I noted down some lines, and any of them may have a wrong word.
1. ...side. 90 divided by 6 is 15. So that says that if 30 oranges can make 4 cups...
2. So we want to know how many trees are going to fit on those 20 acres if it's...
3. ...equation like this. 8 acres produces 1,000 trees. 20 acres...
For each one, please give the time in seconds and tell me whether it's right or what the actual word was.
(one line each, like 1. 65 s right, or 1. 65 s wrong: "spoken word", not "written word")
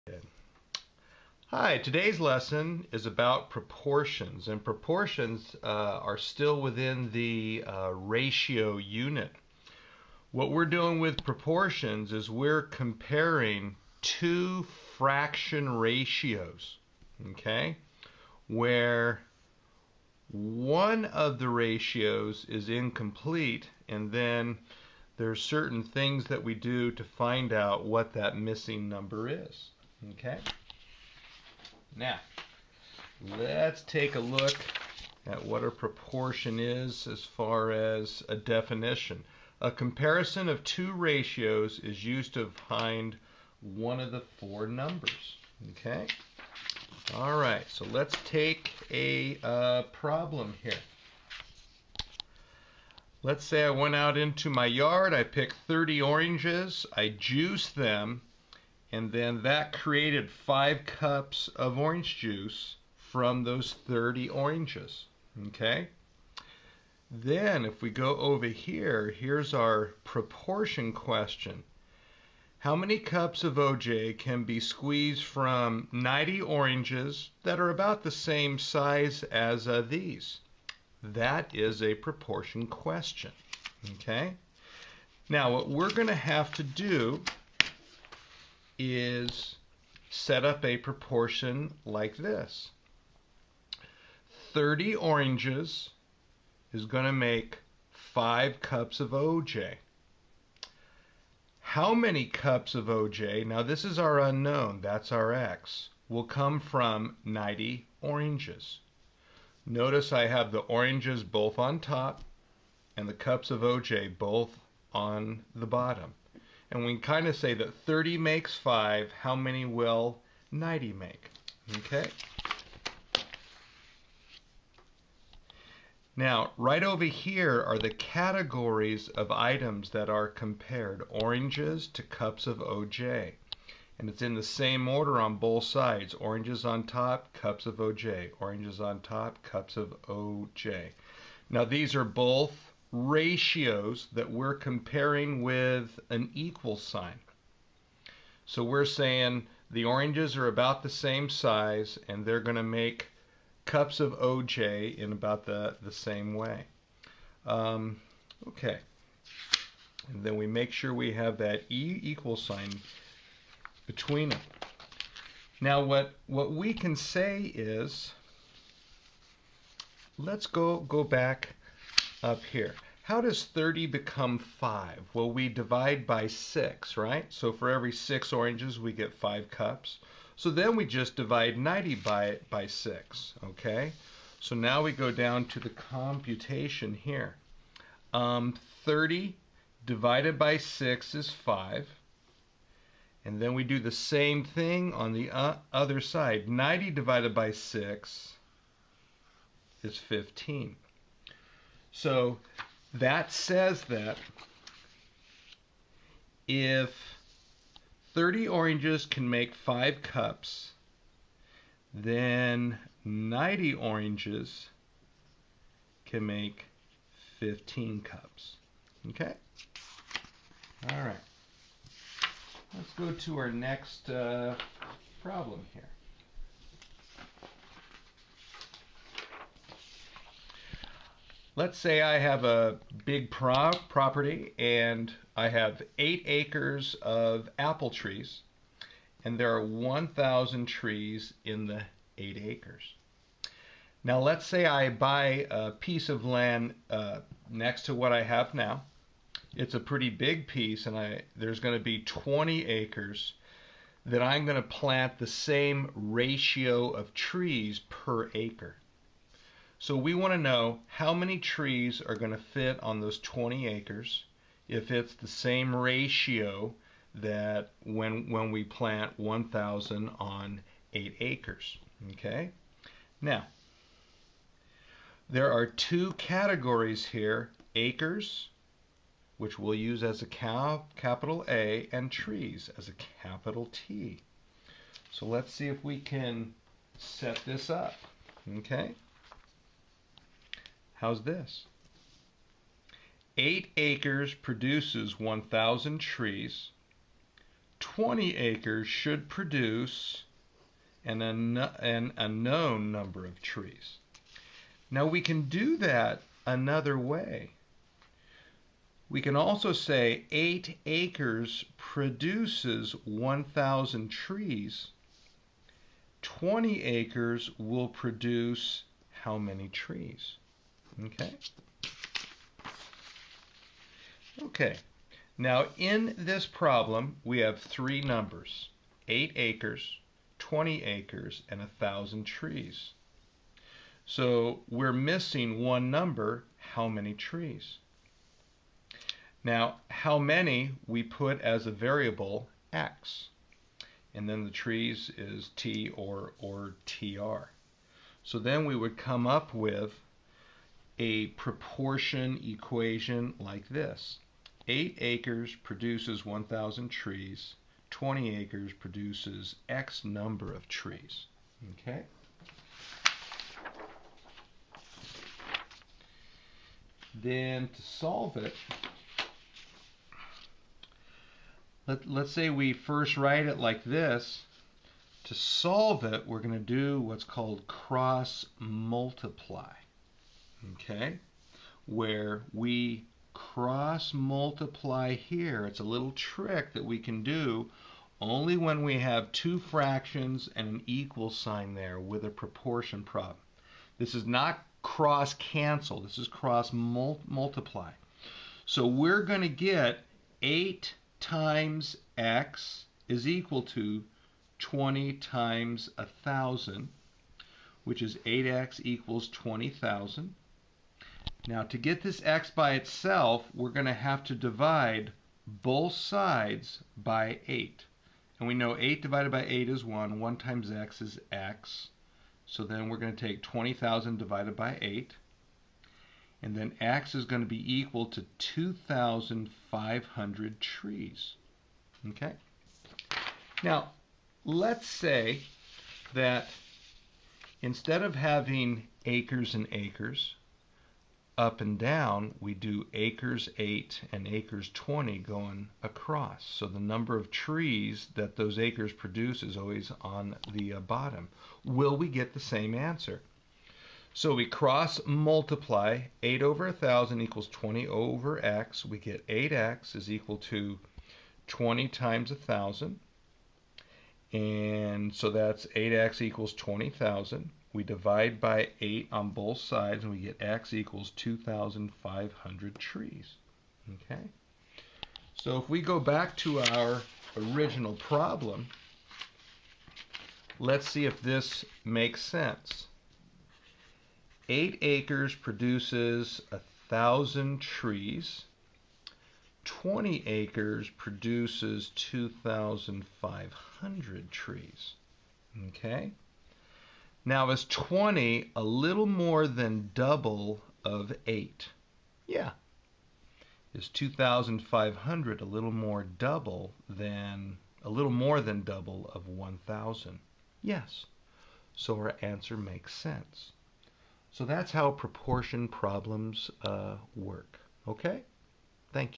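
1. 196 s wrong: "5", not "4"
2. 259 s right
3. 352 s right.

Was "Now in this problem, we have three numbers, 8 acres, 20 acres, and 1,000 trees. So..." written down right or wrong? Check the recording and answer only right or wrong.
right.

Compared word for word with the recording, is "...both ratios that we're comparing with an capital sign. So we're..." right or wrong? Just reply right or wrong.
wrong.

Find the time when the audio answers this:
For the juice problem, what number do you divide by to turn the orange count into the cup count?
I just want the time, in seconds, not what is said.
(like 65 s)
175 s.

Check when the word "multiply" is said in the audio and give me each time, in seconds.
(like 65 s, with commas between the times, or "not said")
378 s, 384 s, 397 s, 455 s.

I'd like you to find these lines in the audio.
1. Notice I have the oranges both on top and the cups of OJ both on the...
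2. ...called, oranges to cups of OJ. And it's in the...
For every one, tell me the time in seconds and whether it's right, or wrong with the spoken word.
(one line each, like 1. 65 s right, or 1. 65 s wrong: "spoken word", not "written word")
1. 109 s right
2. 130 s wrong: "compared", not "called".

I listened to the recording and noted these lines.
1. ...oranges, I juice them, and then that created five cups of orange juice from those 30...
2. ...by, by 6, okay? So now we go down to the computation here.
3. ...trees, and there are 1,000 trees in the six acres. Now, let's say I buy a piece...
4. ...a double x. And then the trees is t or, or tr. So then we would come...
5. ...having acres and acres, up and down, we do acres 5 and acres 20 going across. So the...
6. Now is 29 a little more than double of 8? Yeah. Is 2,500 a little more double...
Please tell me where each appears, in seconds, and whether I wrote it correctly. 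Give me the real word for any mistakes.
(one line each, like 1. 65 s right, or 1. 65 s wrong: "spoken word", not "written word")
1. 56 s right
2. 181 s right
3. 237 s wrong: "eight", not "six"
4. 341 s wrong: "variable", not "double"
5. 438 s wrong: "8", not "5"
6. 497 s wrong: "20", not "29".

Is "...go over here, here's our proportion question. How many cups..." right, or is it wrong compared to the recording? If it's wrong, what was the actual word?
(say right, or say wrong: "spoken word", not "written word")
right.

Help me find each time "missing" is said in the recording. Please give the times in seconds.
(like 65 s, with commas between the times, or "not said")
28 s, 334 s.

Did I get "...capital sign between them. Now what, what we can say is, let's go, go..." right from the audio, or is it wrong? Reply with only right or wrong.
wrong.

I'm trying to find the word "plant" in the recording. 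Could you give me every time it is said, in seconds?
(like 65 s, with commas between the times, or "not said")
254 s, 268 s.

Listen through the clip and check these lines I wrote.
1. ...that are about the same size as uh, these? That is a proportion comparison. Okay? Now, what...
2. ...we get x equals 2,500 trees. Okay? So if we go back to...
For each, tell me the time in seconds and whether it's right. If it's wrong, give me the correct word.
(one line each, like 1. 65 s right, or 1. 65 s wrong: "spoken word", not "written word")
1. 77 s wrong: "question", not "comparison"
2. 470 s right.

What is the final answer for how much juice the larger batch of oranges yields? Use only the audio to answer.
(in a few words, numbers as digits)
15 cups.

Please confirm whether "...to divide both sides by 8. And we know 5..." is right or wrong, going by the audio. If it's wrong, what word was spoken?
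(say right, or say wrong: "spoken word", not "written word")
wrong: "8", not "5".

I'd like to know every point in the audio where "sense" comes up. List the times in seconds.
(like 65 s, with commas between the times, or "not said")
482 s, 512 s.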